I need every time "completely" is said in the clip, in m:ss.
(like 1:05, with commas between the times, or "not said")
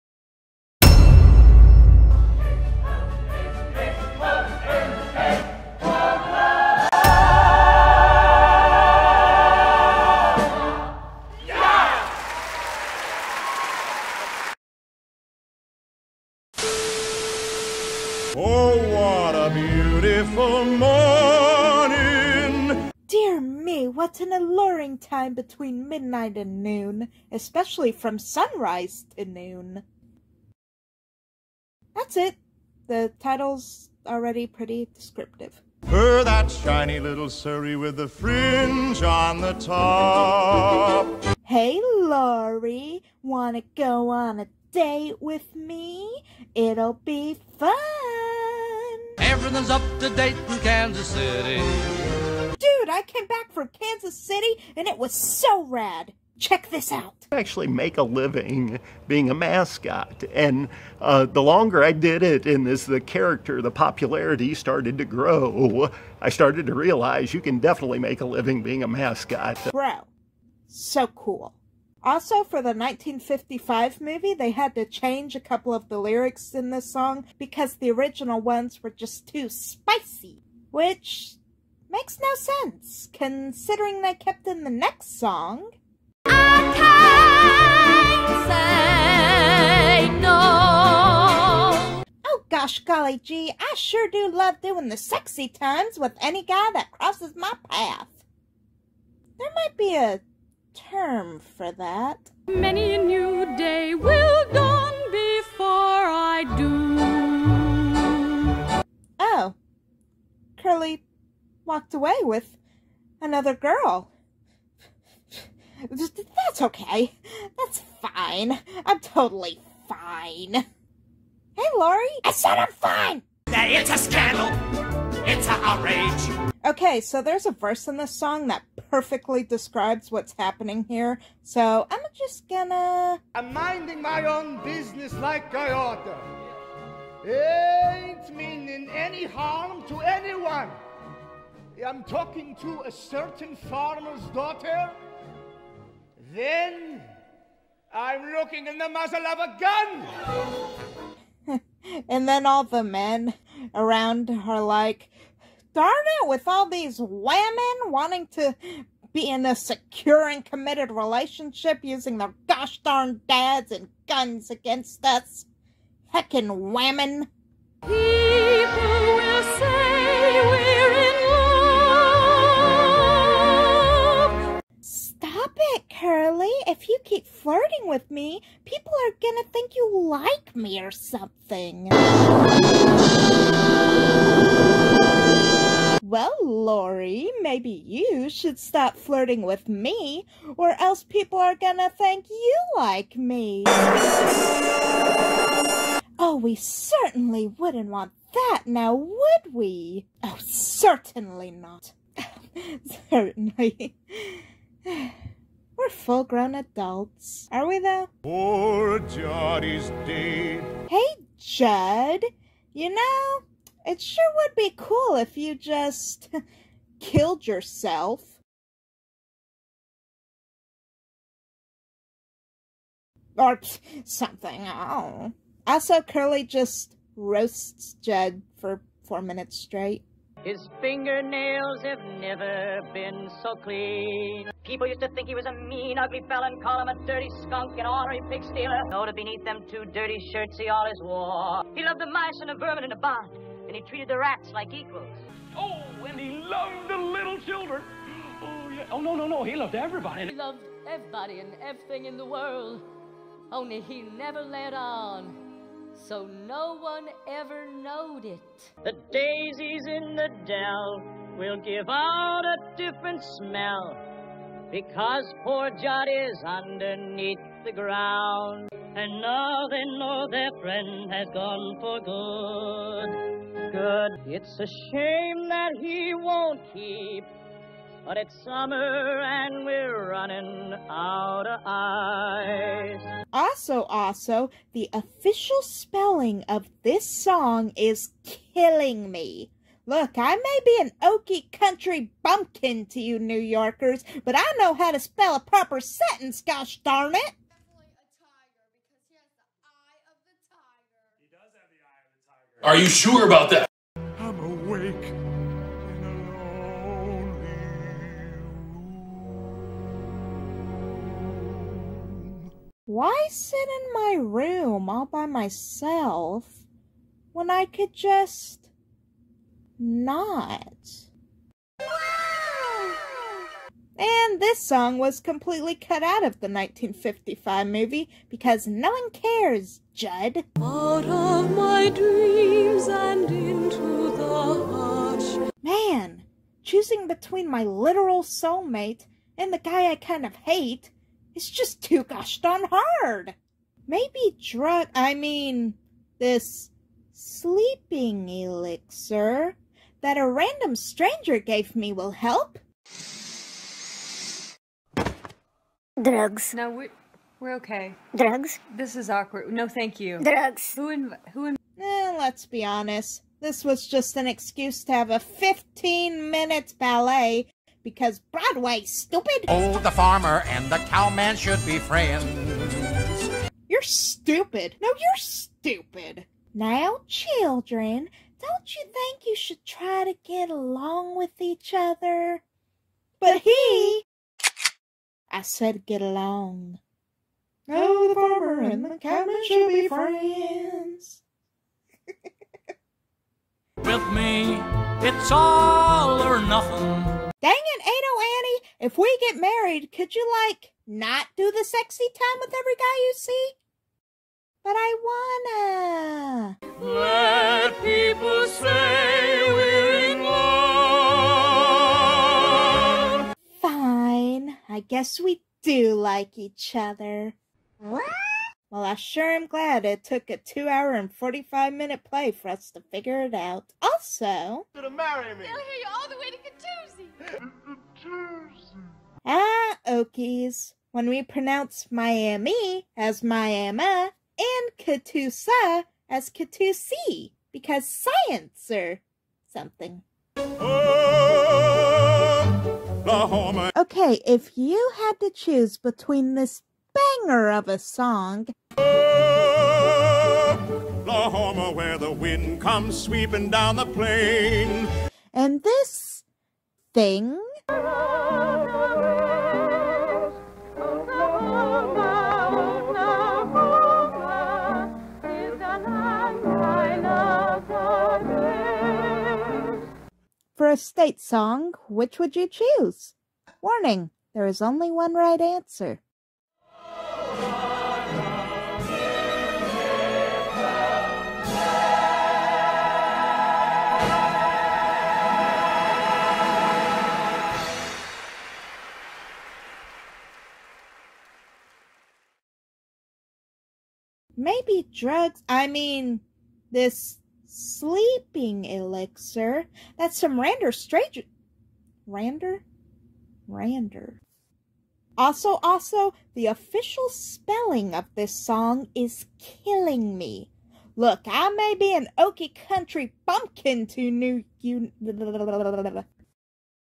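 5:25.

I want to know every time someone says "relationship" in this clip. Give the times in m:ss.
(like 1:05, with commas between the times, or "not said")
2:40.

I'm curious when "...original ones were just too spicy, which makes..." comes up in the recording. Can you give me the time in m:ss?
1:17.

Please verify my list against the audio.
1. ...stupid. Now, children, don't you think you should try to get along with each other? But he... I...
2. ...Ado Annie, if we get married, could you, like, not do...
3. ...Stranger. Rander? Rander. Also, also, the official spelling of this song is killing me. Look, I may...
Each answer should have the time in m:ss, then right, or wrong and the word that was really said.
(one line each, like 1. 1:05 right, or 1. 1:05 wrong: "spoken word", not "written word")
1. 6:15 right
2. 6:37 right
3. 8:20 right.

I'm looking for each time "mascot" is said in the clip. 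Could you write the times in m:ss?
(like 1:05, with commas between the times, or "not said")
0:59, 1:08.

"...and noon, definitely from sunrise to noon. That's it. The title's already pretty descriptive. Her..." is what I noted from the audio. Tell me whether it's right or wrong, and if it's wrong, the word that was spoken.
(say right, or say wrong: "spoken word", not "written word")
wrong: "especially", not "definitely".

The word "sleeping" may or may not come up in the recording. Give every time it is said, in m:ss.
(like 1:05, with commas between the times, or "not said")
5:47, 8:17.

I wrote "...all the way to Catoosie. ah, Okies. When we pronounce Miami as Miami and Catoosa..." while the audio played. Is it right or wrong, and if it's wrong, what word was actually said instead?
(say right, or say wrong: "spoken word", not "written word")
right.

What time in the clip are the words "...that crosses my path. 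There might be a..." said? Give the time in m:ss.
1:36.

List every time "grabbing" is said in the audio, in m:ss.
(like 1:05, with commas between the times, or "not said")
not said.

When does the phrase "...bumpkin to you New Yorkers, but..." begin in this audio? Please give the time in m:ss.
4:52.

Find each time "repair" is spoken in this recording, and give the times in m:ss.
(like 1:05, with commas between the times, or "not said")
not said.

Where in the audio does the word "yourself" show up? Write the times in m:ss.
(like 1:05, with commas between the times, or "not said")
3:37.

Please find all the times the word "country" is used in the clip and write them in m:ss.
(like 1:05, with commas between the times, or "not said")
4:51, 8:32.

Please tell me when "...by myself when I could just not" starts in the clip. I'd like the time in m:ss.
5:15.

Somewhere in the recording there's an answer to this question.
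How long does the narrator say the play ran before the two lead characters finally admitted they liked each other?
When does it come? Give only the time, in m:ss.
7:00.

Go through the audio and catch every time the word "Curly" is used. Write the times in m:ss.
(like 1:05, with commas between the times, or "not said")
1:50, 2:56, 3:46.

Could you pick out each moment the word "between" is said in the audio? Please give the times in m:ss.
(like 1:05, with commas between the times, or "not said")
0:25, 5:37, 7:25.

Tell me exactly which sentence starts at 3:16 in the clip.
Oh, we certainly wouldn't want that now, would we?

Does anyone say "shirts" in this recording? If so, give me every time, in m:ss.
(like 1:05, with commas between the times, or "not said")
4:00.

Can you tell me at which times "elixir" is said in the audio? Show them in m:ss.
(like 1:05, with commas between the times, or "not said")
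5:48, 8:18.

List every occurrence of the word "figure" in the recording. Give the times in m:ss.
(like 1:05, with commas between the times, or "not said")
7:02.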